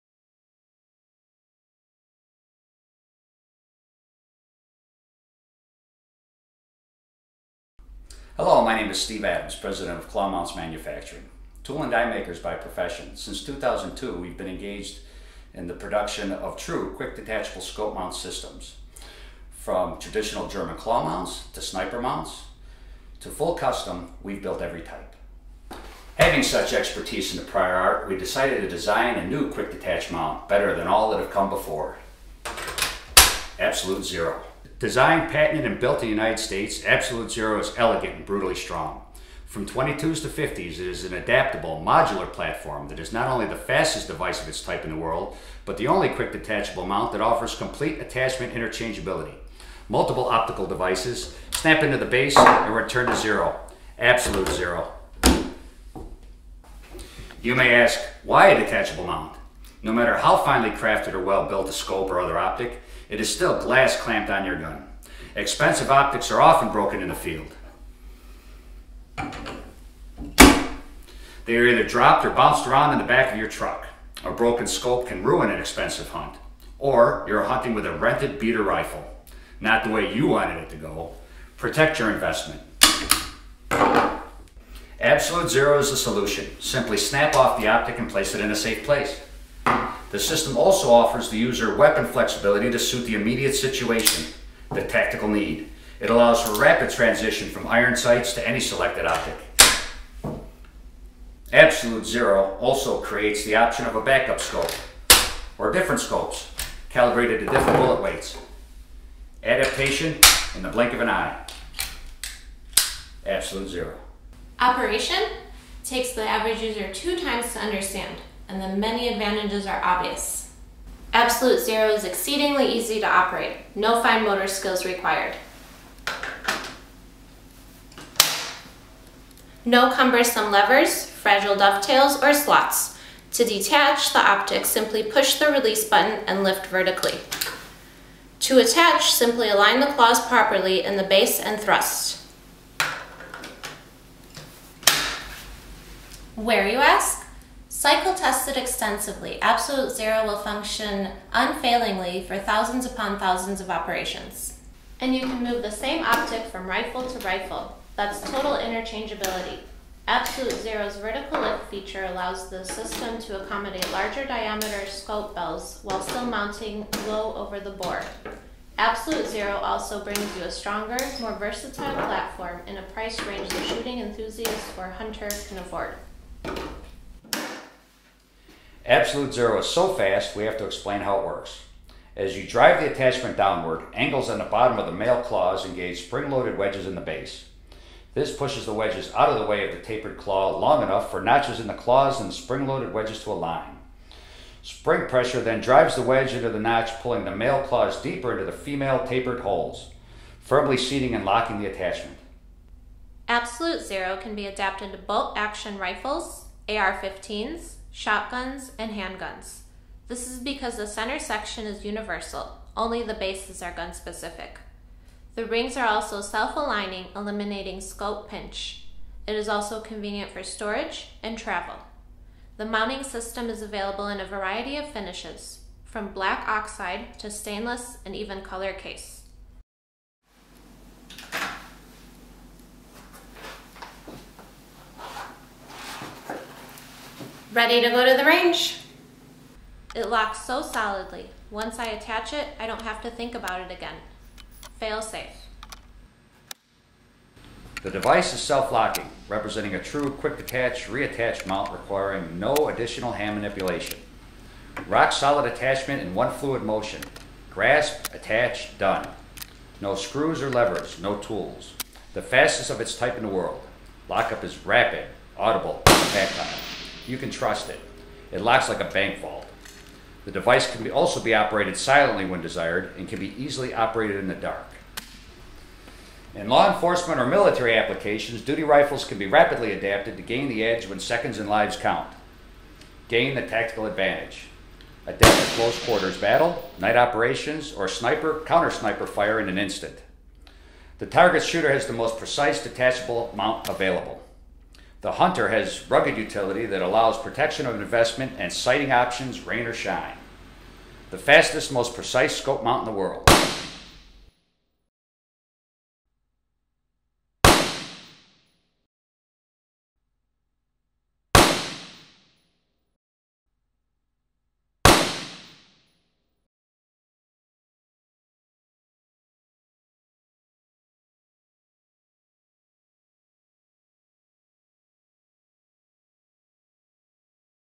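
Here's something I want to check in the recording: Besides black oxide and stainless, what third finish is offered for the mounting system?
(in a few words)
color case.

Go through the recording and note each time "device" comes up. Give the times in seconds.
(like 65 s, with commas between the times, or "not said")
44 s, 50 s, 247 s, 270 s.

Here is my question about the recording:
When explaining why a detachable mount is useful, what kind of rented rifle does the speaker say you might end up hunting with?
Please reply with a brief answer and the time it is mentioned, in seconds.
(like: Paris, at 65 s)
beater rifle, at 78 s.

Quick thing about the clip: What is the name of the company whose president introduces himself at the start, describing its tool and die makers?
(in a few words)
Clawmounts Manufacturing.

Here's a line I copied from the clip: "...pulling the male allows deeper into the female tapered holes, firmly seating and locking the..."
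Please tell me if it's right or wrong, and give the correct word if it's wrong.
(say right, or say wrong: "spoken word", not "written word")
wrong: "claws", not "allows".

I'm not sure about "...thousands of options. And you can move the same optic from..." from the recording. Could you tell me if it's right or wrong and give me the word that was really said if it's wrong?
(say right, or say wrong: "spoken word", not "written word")
wrong: "operations", not "options".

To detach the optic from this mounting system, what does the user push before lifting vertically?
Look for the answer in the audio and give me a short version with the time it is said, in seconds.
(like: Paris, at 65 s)
release button, at 135 s.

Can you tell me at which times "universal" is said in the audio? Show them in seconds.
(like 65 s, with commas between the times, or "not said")
211 s.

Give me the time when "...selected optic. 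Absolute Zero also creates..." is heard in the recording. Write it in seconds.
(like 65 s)
98 s.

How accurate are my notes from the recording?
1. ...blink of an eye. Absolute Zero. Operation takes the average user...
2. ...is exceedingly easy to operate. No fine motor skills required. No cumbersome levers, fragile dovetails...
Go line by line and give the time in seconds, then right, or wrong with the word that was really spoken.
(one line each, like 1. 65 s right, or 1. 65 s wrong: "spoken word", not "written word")
1. 110 s right
2. 121 s right.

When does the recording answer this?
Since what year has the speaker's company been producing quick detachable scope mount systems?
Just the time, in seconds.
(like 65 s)
13 s.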